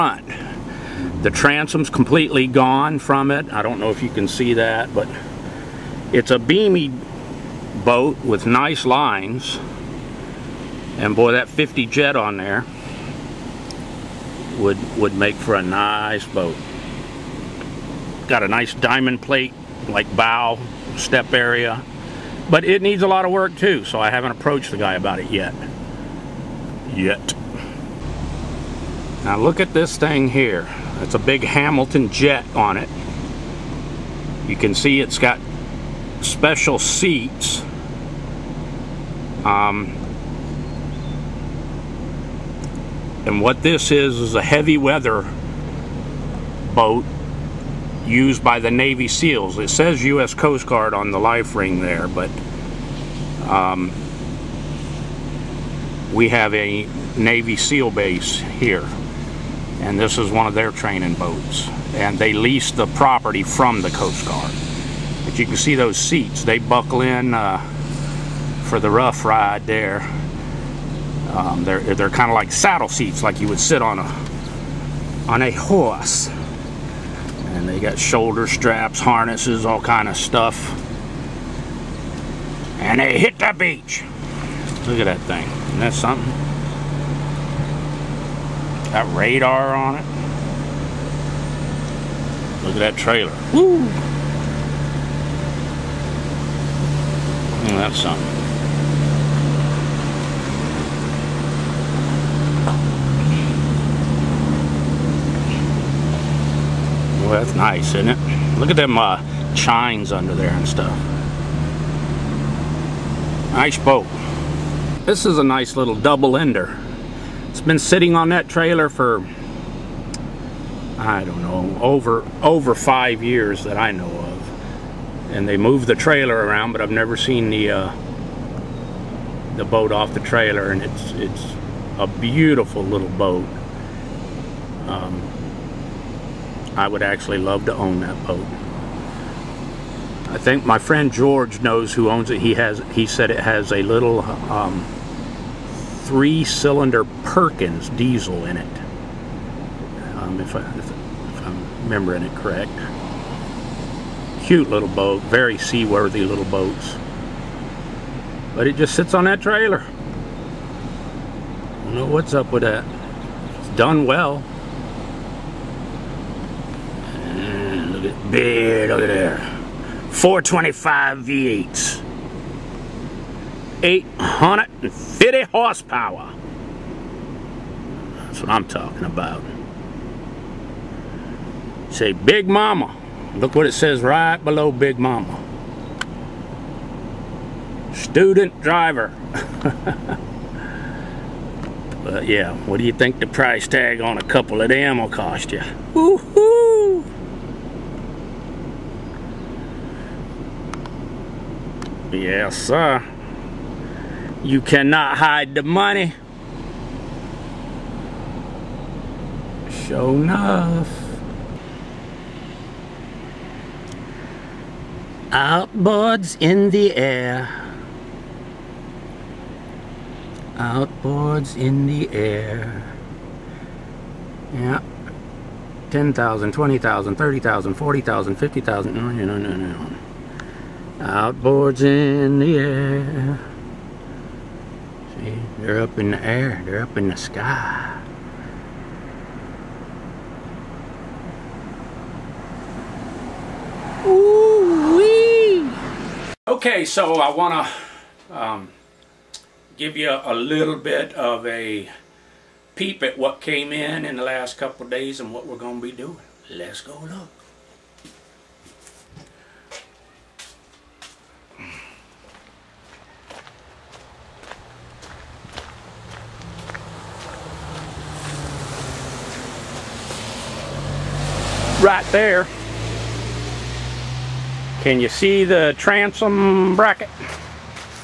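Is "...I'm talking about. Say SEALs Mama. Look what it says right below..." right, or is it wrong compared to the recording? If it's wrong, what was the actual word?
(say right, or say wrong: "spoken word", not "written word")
wrong: "Big", not "SEALs".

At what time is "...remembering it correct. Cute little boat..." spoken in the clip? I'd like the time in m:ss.
2:31.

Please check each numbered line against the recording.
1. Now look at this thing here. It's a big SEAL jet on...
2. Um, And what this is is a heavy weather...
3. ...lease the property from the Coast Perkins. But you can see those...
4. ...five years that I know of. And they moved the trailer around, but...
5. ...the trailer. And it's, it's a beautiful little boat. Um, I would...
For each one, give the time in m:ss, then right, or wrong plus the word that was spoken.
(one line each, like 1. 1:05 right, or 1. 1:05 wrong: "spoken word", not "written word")
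1. 0:29 wrong: "Hamilton", not "SEAL"
2. 0:39 right
3. 1:02 wrong: "Guard", not "Perkins"
4. 2:02 right
5. 2:10 right.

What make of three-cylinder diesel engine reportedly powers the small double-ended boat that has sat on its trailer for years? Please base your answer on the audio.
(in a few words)
Perkins.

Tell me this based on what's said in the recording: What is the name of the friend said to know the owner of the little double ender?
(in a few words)
George.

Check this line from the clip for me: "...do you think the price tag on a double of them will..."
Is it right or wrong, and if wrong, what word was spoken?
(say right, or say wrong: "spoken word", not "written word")
wrong: "couple", not "double".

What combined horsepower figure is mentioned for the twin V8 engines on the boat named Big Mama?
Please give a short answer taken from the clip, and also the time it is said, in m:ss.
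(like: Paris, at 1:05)
850, at 2:53.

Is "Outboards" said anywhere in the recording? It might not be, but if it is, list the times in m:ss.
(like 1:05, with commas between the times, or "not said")
3:35, 3:40, 3:50.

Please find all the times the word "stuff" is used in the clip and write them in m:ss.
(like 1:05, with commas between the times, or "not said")
1:20, 1:50.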